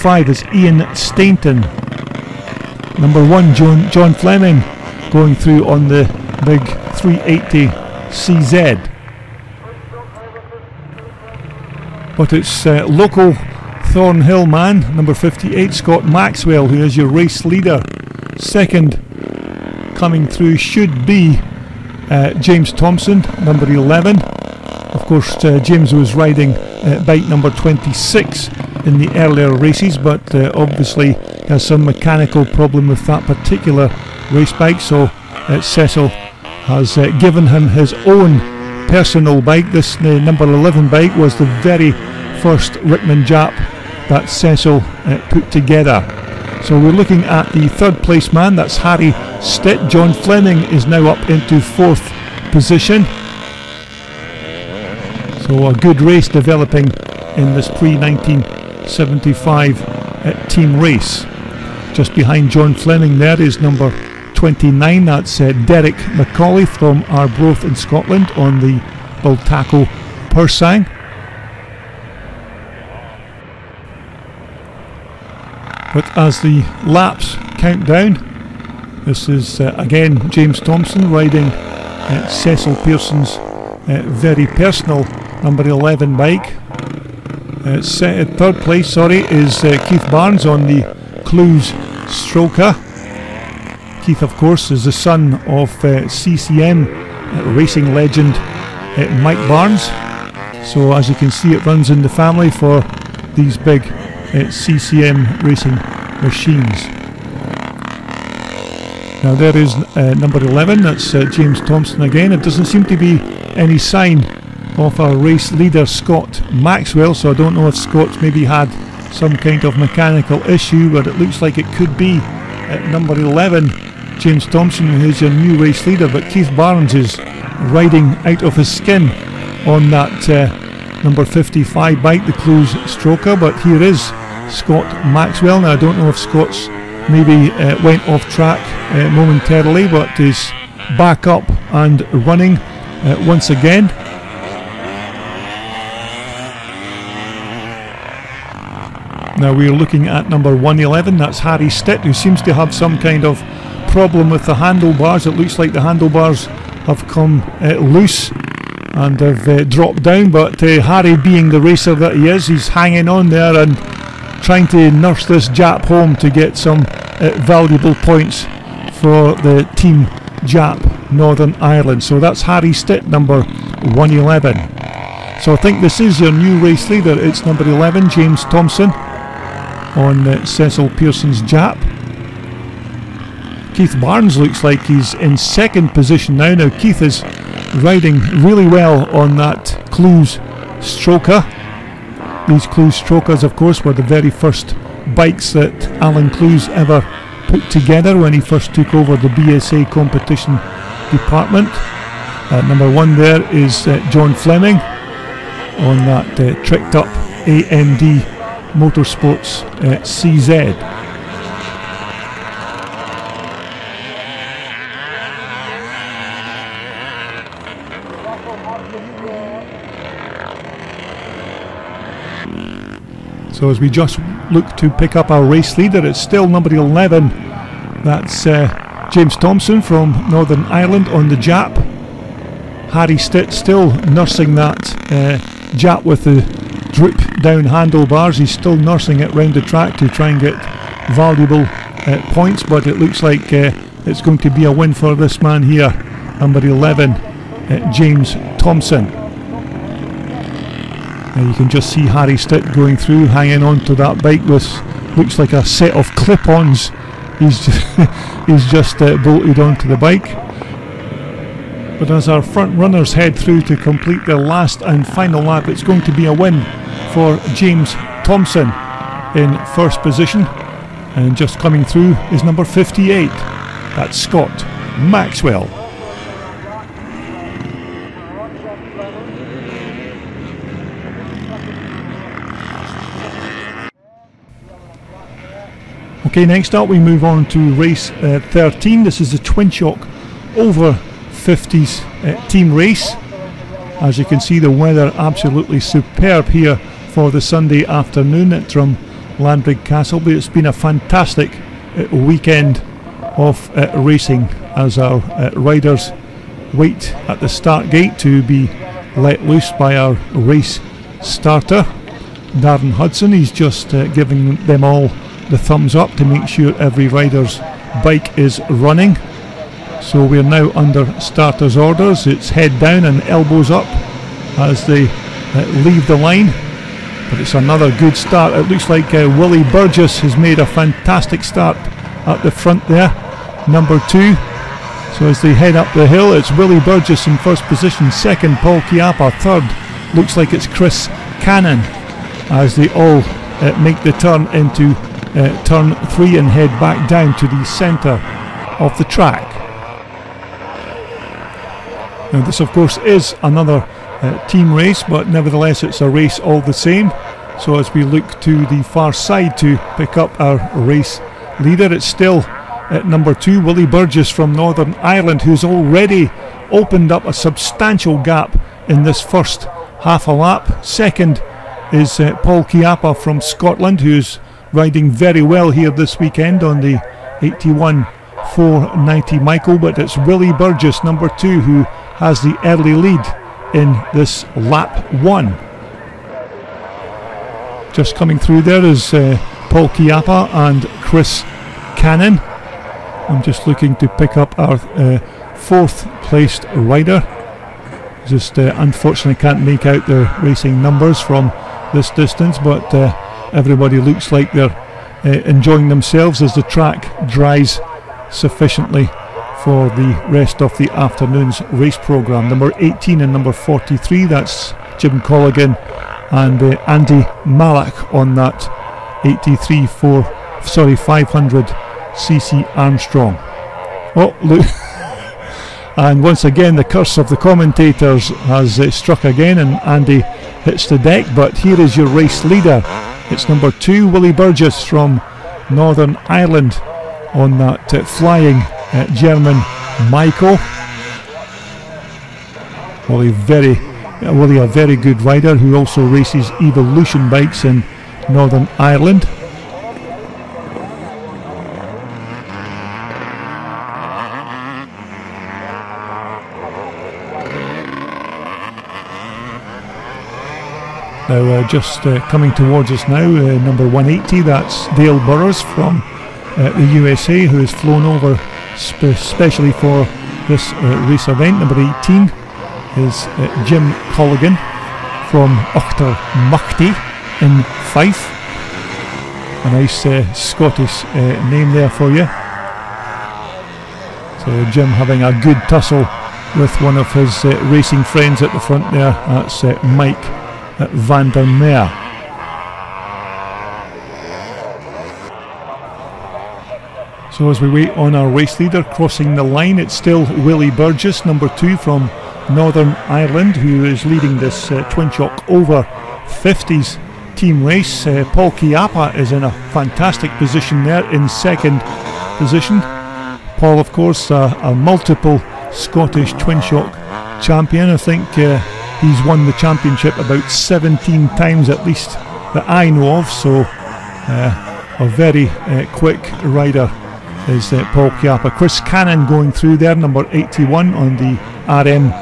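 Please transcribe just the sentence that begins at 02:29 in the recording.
Now we're looking at number 111, that's Harry Stitt, who seems to have some kind of problem with the handlebars.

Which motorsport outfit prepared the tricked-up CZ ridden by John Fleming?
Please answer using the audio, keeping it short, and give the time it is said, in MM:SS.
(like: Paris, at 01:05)
AMD Motorsports, at 03:27.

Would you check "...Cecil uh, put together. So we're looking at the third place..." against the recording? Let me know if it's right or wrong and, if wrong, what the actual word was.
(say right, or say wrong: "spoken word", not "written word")
right.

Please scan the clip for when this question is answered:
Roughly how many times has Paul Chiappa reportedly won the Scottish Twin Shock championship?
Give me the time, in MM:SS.
08:40.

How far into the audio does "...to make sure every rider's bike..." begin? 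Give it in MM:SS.
05:16.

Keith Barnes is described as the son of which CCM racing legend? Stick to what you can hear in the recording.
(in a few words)
Mike Barnes.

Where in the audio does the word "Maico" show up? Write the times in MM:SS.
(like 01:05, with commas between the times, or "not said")
06:19, 07:20.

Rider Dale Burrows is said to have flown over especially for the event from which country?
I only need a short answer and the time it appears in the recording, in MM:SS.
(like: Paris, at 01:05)
USA, at 07:46.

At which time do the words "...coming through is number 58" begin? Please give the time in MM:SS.
04:31.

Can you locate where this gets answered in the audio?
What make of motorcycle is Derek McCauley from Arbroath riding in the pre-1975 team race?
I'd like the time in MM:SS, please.
01:09.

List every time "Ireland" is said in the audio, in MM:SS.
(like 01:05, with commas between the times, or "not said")
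02:51, 03:50, 06:04, 07:16, 07:28, 08:23.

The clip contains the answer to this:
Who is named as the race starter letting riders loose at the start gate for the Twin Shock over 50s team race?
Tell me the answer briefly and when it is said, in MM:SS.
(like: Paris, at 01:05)
Darren Hudson, at 05:12.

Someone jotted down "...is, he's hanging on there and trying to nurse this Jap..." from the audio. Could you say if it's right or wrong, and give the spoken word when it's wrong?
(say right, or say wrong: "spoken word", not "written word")
right.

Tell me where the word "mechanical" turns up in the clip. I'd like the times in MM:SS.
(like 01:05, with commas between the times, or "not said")
00:31, 01:59.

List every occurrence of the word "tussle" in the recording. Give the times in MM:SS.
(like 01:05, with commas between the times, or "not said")
08:05.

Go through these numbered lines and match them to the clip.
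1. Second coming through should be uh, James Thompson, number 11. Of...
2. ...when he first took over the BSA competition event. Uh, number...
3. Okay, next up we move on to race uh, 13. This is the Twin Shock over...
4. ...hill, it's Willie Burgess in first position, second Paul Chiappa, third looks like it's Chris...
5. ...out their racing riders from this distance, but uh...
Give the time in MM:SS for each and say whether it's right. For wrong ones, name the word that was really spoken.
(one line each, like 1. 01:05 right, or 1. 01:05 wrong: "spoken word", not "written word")
1. 00:18 right
2. 03:18 wrong: "department", not "event"
3. 04:46 right
4. 05:36 right
5. 06:39 wrong: "numbers", not "riders".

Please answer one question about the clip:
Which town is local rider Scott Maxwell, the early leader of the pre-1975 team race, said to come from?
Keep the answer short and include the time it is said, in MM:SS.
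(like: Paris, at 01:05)
Thornhill, at 00:13.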